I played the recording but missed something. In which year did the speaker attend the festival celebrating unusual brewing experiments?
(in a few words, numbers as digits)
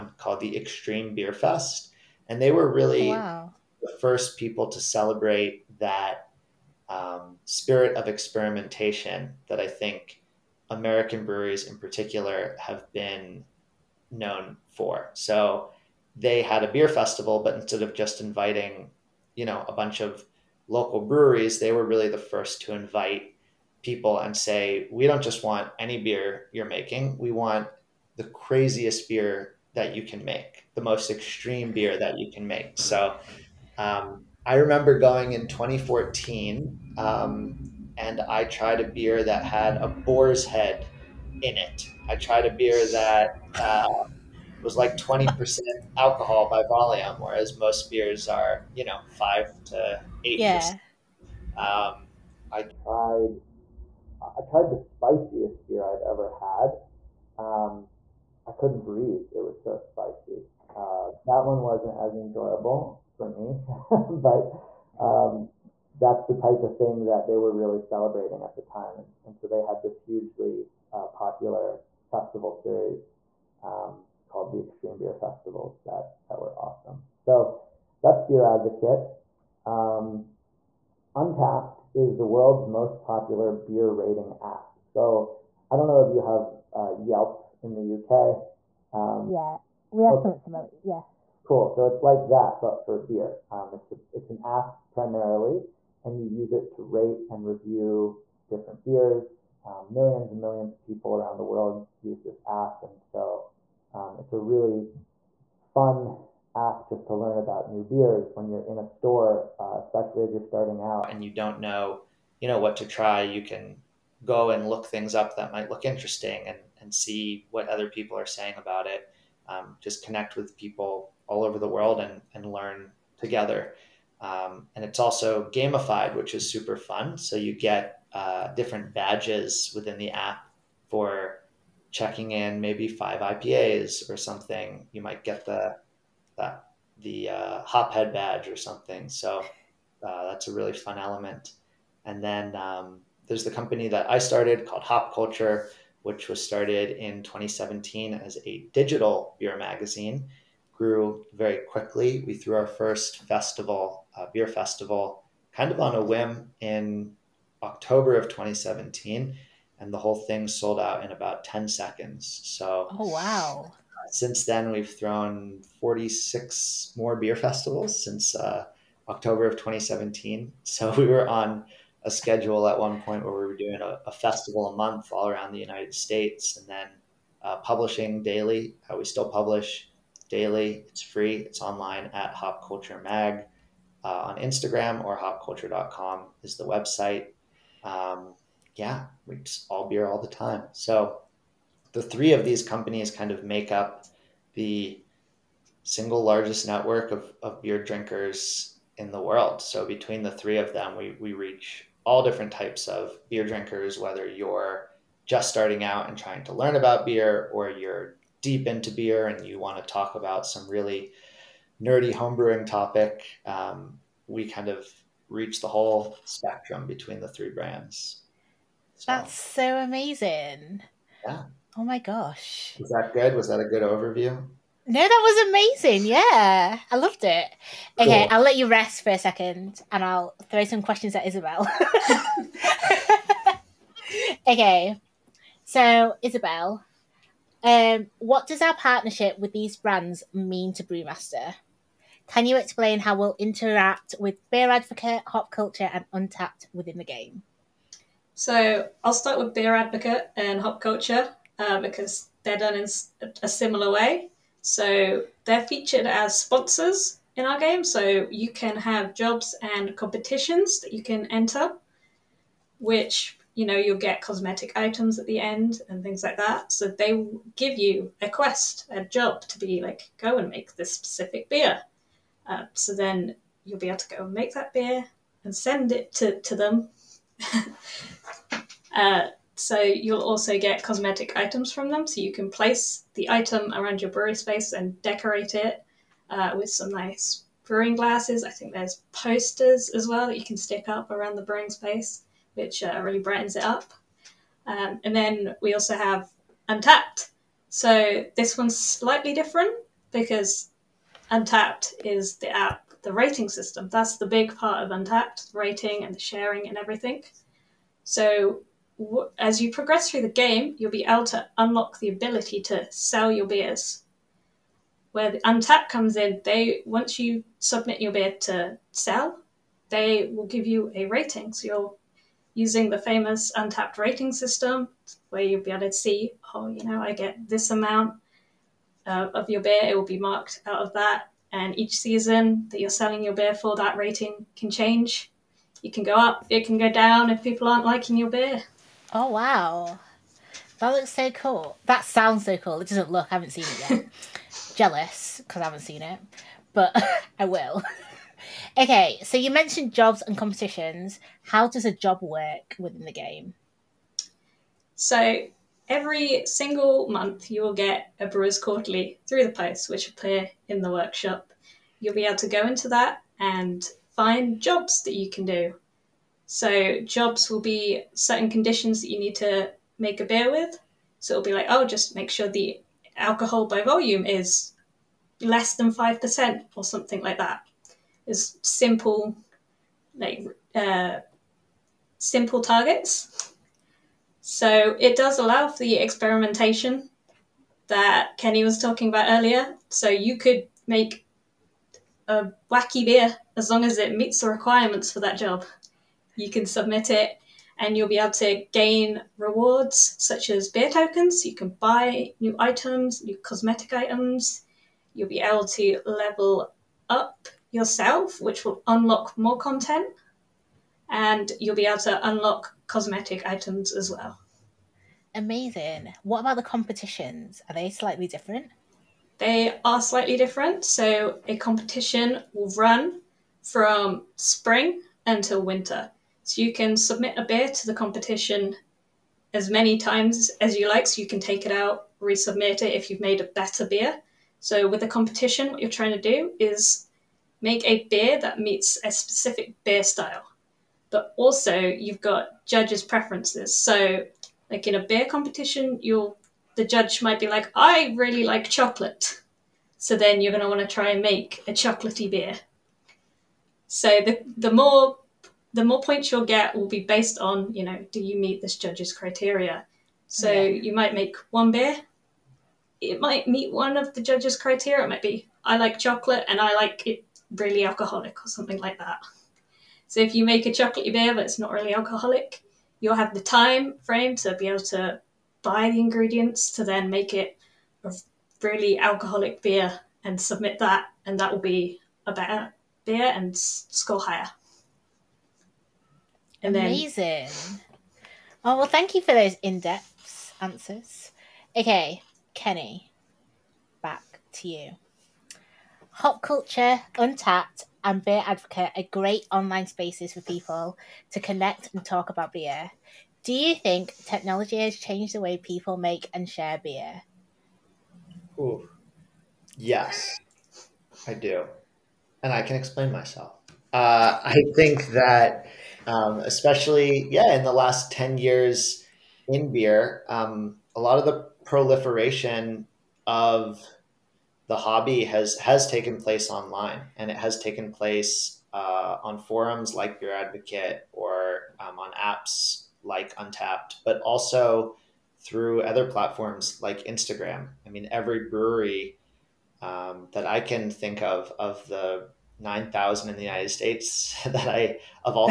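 2014.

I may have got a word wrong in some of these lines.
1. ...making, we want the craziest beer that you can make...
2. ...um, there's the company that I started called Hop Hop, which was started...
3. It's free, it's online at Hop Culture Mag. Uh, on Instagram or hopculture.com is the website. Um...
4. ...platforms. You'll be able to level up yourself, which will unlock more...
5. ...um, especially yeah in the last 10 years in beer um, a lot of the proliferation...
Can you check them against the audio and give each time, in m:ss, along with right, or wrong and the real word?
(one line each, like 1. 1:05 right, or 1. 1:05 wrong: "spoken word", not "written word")
1. 0:26 right
2. 2:22 wrong: "Culture", not "Hop"
3. 3:00 right
4. 6:43 wrong: "items", not "platforms"
5. 8:36 right.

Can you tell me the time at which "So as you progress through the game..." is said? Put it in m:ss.
5:08.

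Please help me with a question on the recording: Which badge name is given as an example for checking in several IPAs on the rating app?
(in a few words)
Hophead.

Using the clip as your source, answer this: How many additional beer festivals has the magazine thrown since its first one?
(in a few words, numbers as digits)
46.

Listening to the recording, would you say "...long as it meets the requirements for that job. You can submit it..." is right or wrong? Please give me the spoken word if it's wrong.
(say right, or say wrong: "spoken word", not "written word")
right.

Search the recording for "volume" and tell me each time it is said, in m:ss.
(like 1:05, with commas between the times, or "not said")
0:46, 6:13.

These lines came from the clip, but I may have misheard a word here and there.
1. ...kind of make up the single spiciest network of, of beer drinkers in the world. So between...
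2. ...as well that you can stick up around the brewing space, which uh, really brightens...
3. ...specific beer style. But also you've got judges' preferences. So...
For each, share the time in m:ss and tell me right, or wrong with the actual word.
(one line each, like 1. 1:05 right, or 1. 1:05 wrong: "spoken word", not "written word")
1. 3:13 wrong: "largest", not "spiciest"
2. 4:49 right
3. 7:19 right.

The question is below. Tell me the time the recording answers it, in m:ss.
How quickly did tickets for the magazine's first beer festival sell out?
2:41.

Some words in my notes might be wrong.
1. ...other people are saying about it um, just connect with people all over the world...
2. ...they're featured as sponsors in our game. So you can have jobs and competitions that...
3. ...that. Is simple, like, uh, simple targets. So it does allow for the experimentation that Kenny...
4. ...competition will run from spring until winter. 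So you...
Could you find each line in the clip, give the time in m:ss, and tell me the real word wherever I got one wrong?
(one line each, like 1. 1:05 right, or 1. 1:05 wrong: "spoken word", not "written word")
1. 1:57 right
2. 4:15 right
3. 6:17 right
4. 7:01 right.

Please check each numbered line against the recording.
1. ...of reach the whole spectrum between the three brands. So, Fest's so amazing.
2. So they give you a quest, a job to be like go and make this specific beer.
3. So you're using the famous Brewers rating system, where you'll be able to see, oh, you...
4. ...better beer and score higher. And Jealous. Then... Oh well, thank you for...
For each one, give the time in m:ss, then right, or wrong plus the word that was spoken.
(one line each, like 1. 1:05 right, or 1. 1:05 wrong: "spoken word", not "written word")
1. 3:34 wrong: "That", not "Fest"
2. 4:26 right
3. 5:21 wrong: "Untappd", not "Brewers"
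4. 8:02 wrong: "Amazing", not "Jealous".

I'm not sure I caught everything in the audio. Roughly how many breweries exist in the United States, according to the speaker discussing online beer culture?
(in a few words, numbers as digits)
9,000.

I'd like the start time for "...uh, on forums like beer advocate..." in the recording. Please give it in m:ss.
8:48.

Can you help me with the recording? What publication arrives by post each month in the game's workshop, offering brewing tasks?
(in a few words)
Brewers Quarterly.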